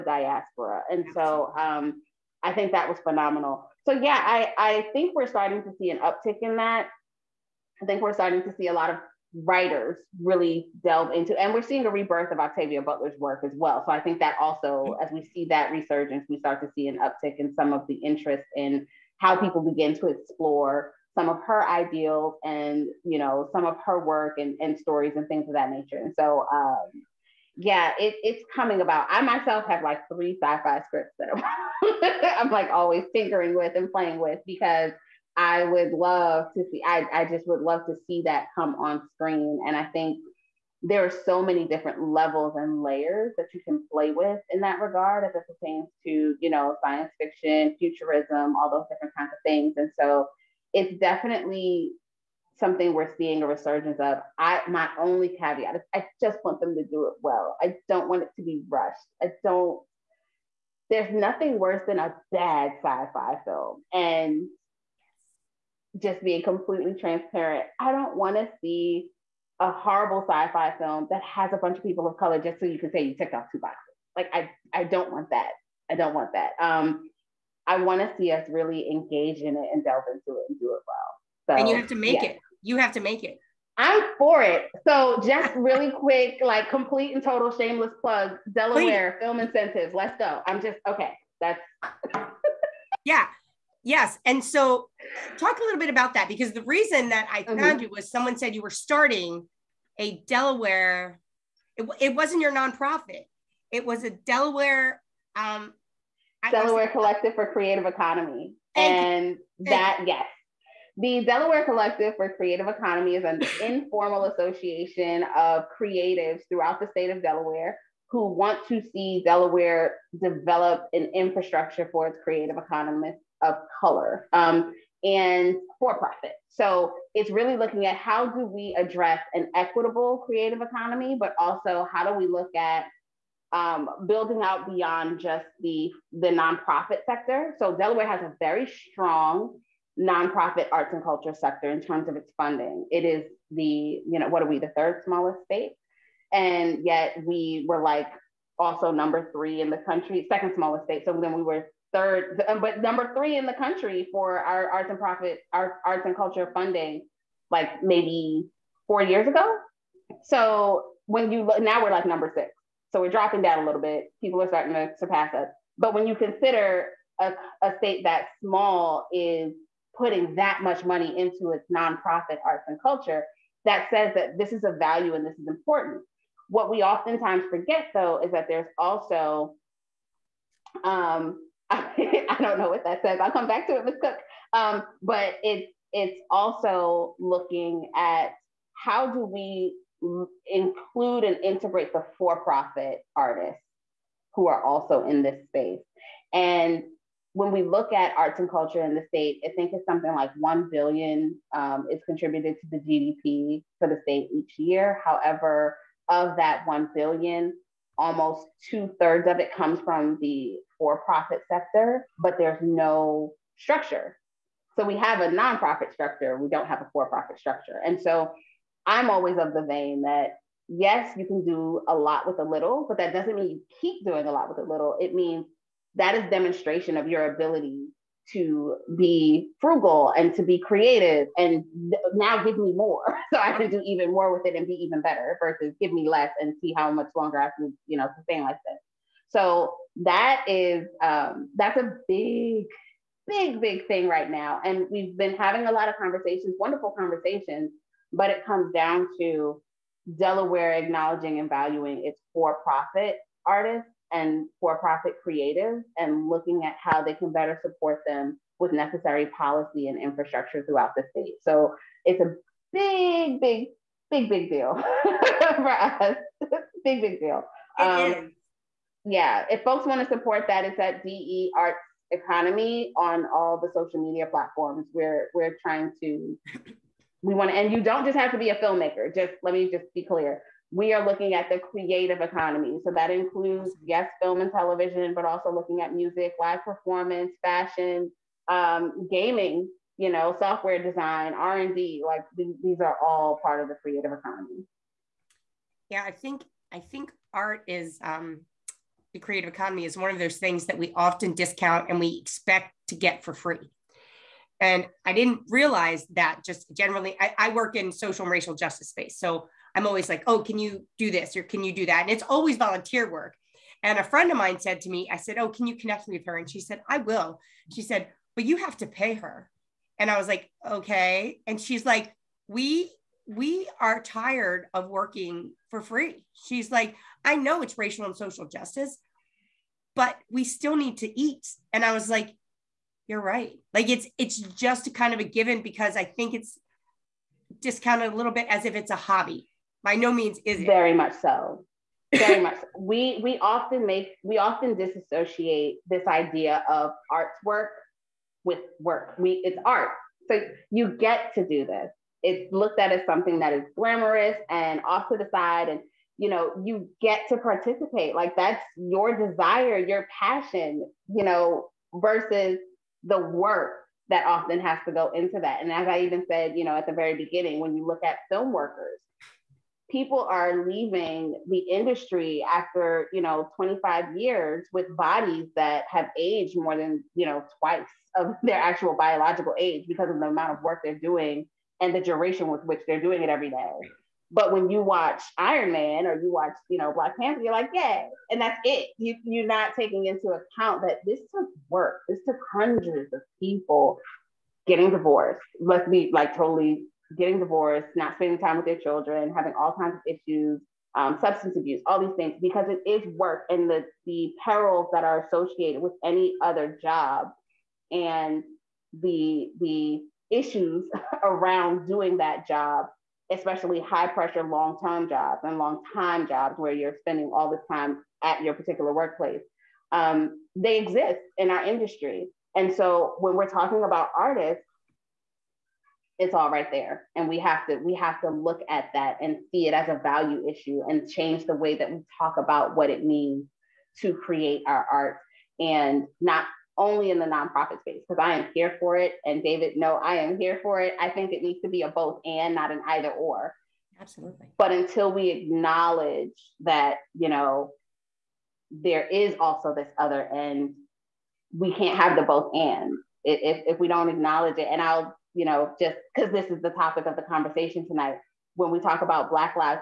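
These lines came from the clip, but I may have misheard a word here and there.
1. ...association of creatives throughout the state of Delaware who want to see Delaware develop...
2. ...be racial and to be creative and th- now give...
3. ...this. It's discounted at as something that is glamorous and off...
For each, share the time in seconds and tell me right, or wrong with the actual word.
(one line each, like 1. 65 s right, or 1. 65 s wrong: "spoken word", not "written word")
1. 114 s right
2. 228 s wrong: "frugal", not "racial"
3. 351 s wrong: "looked", not "discounted".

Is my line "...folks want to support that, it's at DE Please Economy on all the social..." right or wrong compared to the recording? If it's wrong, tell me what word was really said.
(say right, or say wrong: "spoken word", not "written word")
wrong: "Arts", not "Please".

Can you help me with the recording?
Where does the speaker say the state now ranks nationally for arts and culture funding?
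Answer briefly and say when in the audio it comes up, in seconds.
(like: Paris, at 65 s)
6, at 162 s.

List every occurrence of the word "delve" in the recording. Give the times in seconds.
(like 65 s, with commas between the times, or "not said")
10 s, 79 s.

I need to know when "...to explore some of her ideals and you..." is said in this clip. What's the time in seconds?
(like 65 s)
19 s.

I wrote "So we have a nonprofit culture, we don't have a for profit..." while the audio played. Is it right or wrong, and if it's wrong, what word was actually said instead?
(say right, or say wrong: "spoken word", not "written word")
wrong: "structure", not "culture".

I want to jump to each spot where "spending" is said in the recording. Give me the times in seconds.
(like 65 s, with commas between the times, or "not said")
398 s, 416 s.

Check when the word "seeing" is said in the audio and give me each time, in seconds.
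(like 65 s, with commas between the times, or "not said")
11 s, 53 s.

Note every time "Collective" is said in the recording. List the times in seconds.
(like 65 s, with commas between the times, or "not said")
106 s, 111 s.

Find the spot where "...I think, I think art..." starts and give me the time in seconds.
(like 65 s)
296 s.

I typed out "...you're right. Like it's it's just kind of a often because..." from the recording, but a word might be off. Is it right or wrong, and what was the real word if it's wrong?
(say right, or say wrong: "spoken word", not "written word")
wrong: "given", not "often".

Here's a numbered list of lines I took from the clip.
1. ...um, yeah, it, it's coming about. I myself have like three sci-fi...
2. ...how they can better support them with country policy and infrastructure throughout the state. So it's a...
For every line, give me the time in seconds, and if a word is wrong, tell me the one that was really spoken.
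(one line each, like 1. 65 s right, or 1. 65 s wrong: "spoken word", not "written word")
1. 26 s right
2. 256 s wrong: "necessary", not "country".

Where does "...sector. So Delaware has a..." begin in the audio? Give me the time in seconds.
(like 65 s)
137 s.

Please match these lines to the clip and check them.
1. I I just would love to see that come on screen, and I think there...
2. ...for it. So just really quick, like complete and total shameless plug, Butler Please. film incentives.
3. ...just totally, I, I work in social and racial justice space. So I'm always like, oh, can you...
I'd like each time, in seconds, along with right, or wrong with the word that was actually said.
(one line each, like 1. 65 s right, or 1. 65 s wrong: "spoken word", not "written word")
1. 36 s right
2. 84 s wrong: "Delaware", not "Butler"
3. 306 s wrong: "generally", not "totally".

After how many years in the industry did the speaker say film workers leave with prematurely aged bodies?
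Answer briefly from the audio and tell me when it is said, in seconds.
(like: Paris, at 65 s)
25, at 373 s.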